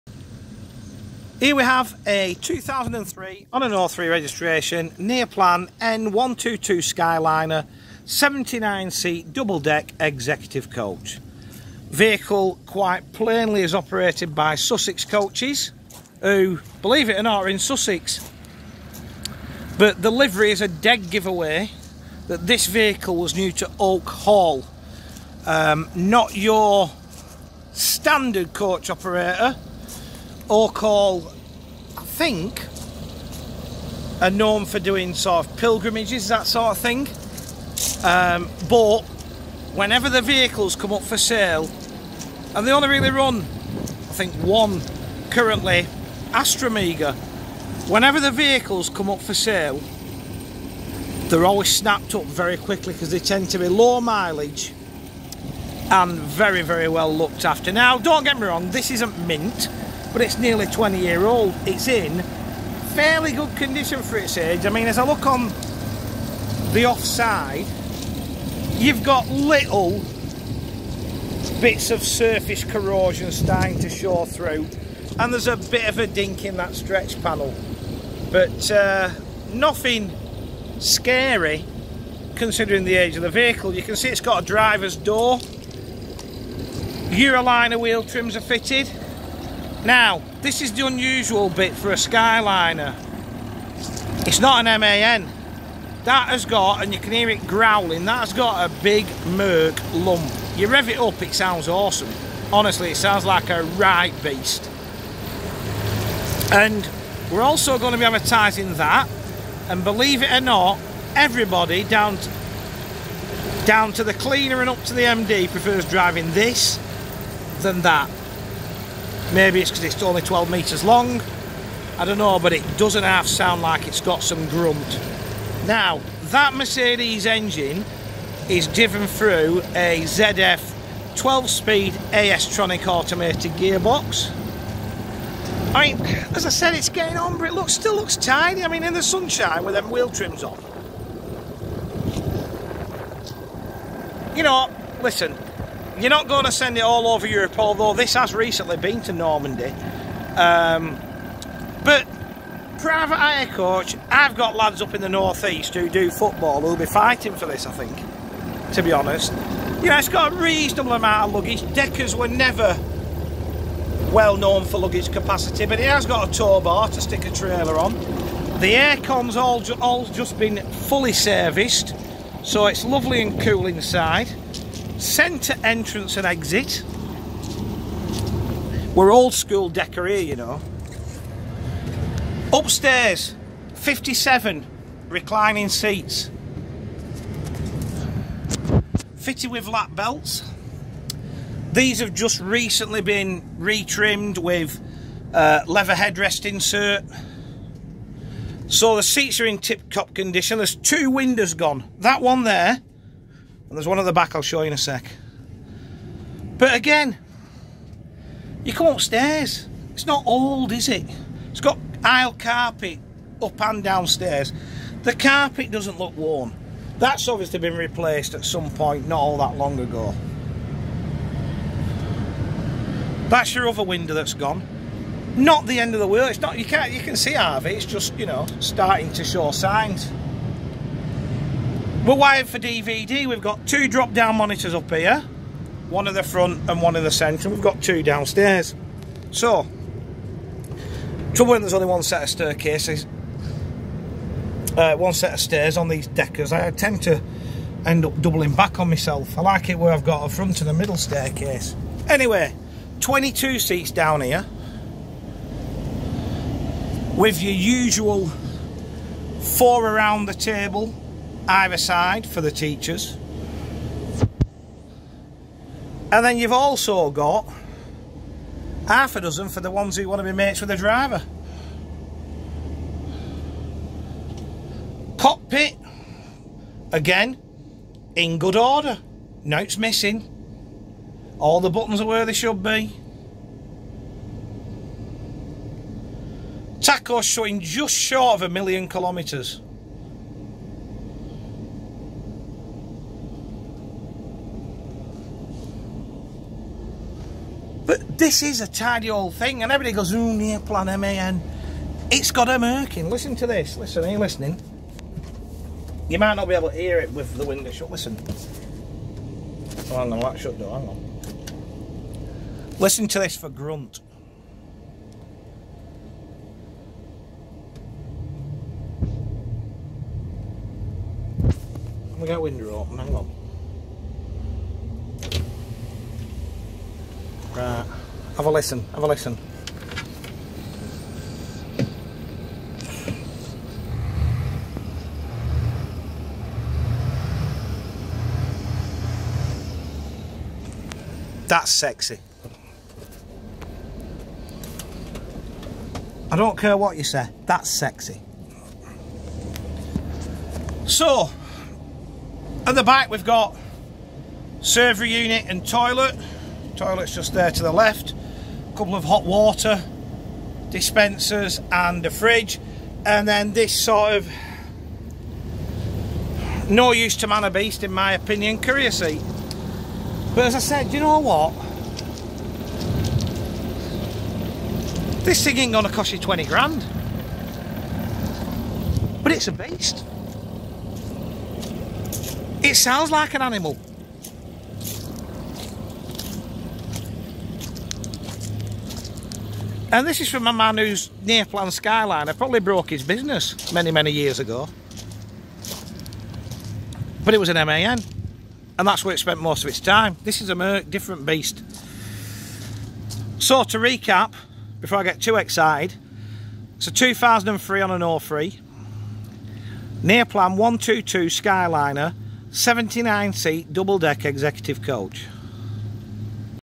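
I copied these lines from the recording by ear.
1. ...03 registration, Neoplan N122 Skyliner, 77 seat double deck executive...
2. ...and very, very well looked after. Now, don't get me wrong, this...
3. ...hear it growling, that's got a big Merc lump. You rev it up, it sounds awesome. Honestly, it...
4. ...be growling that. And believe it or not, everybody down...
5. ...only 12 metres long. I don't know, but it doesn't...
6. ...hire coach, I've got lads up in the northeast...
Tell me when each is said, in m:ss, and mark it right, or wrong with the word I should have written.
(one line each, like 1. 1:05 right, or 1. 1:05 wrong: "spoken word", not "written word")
1. 0:03 wrong: "79", not "77"
2. 0:55 right
3. 1:37 right
4. 1:47 wrong: "advertising", not "growling"
5. 2:00 right
6. 2:33 right.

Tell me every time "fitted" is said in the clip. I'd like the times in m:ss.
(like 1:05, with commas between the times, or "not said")
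1:28, 3:09.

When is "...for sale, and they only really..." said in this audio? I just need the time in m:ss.
0:41.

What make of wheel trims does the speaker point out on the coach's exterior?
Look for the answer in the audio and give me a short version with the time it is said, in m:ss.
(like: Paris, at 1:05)
Euroliner, at 1:27.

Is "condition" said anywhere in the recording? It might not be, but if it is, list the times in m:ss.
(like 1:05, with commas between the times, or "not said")
1:03, 3:20.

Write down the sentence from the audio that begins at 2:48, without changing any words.
The aircon's all, all just been fully serviced, so it's lovely and cool inside.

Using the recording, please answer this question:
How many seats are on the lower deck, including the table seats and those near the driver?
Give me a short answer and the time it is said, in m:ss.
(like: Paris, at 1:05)
22, at 4:13.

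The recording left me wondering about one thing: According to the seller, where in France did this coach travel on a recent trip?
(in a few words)
Normandy.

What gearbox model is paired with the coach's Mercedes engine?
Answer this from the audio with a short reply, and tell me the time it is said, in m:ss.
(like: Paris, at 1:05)
ZF 12-speed AS-tronic, at 2:10.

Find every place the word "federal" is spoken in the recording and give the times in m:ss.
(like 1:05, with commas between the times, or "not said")
not said.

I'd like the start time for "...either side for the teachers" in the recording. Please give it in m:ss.
4:21.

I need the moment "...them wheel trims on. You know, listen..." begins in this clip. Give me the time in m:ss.
2:19.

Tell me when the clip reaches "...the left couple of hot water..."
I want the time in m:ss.
5:57.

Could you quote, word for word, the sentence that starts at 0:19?
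But the livery is a dead giveaway that this vehicle was new to Oak Hall.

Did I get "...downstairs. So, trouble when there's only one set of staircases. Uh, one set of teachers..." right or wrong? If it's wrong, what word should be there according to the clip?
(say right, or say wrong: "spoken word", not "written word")
wrong: "stairs", not "teachers".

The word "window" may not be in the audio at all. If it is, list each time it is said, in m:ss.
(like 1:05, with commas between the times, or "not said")
3:21, 3:43, 5:07, 5:22.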